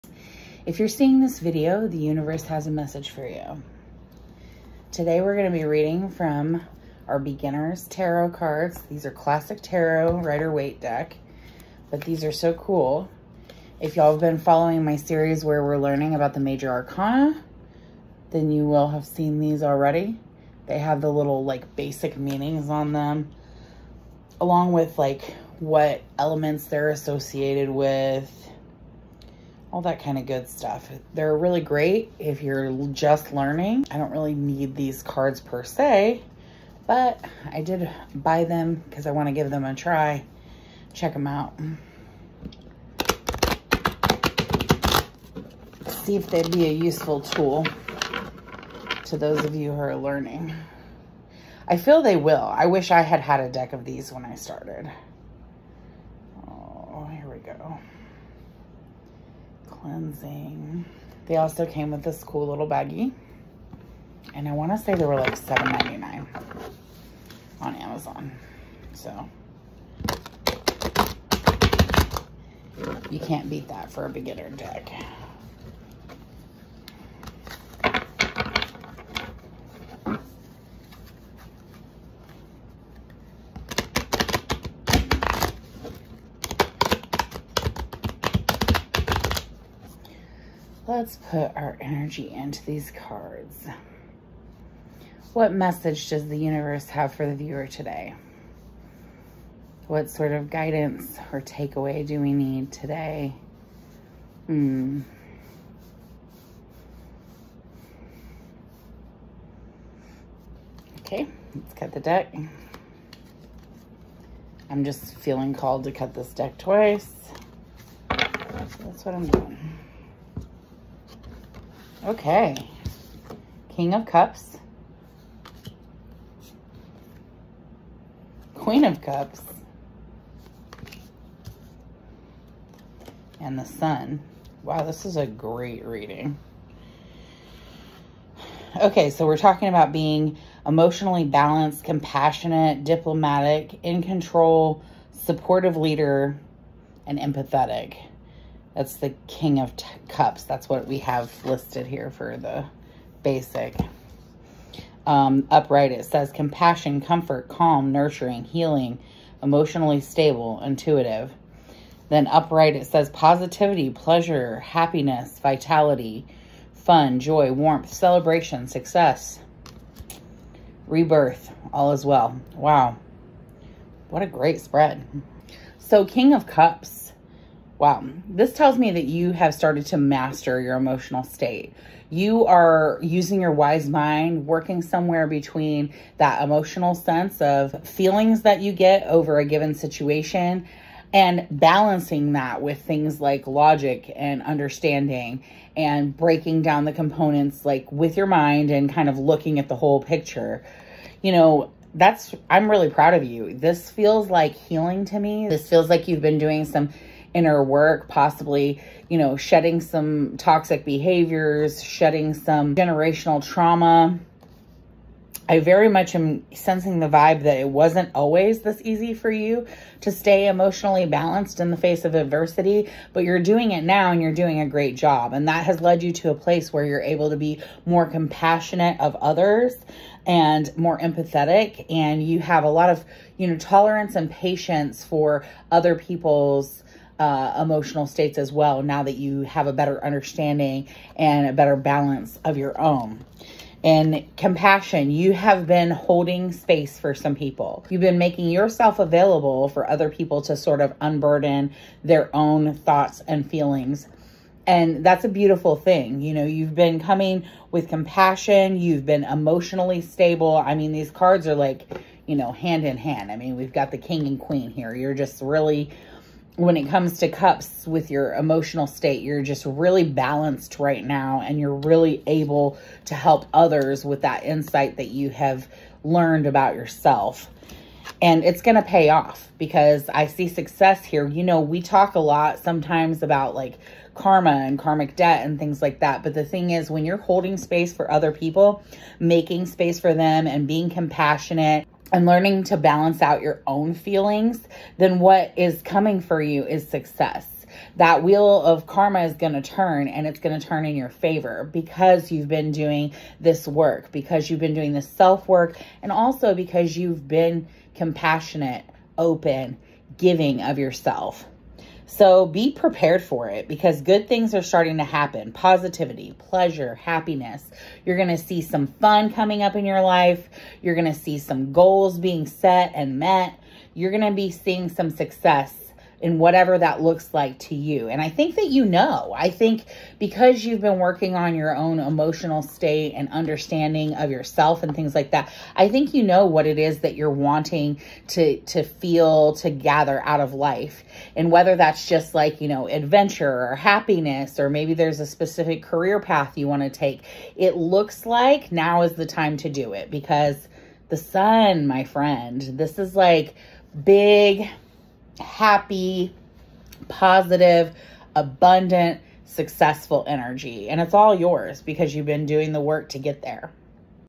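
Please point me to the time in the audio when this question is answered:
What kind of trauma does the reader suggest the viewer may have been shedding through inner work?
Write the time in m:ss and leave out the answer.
3:32.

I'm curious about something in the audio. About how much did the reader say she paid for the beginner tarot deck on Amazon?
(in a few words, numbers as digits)
$7.99.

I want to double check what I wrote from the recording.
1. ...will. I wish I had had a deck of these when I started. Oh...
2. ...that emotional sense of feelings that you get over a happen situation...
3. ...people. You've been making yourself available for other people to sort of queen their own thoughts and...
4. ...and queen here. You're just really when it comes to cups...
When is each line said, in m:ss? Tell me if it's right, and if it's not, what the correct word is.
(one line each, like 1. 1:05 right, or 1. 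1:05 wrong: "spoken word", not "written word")
1. 0:52 right
2. 3:06 wrong: "given", not "happen"
3. 4:07 wrong: "unburden", not "queen"
4. 4:24 right.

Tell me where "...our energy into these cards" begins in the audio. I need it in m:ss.
1:31.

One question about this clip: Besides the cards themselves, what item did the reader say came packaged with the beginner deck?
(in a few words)
little baggie.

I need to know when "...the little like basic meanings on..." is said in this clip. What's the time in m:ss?
0:21.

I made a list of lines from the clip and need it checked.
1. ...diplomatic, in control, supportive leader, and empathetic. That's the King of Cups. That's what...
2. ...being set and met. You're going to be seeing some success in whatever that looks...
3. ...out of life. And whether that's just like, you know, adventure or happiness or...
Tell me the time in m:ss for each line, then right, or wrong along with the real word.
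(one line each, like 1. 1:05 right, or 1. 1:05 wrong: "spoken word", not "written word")
1. 2:22 right
2. 5:22 right
3. 5:40 right.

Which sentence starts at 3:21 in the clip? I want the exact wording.
You know, that's, I'm really proud of you.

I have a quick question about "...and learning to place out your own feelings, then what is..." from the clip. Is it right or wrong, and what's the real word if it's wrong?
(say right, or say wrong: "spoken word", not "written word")
wrong: "balance", not "place".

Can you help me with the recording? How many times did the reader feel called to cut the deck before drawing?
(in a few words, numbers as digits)
twice.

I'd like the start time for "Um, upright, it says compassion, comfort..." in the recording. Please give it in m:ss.
2:35.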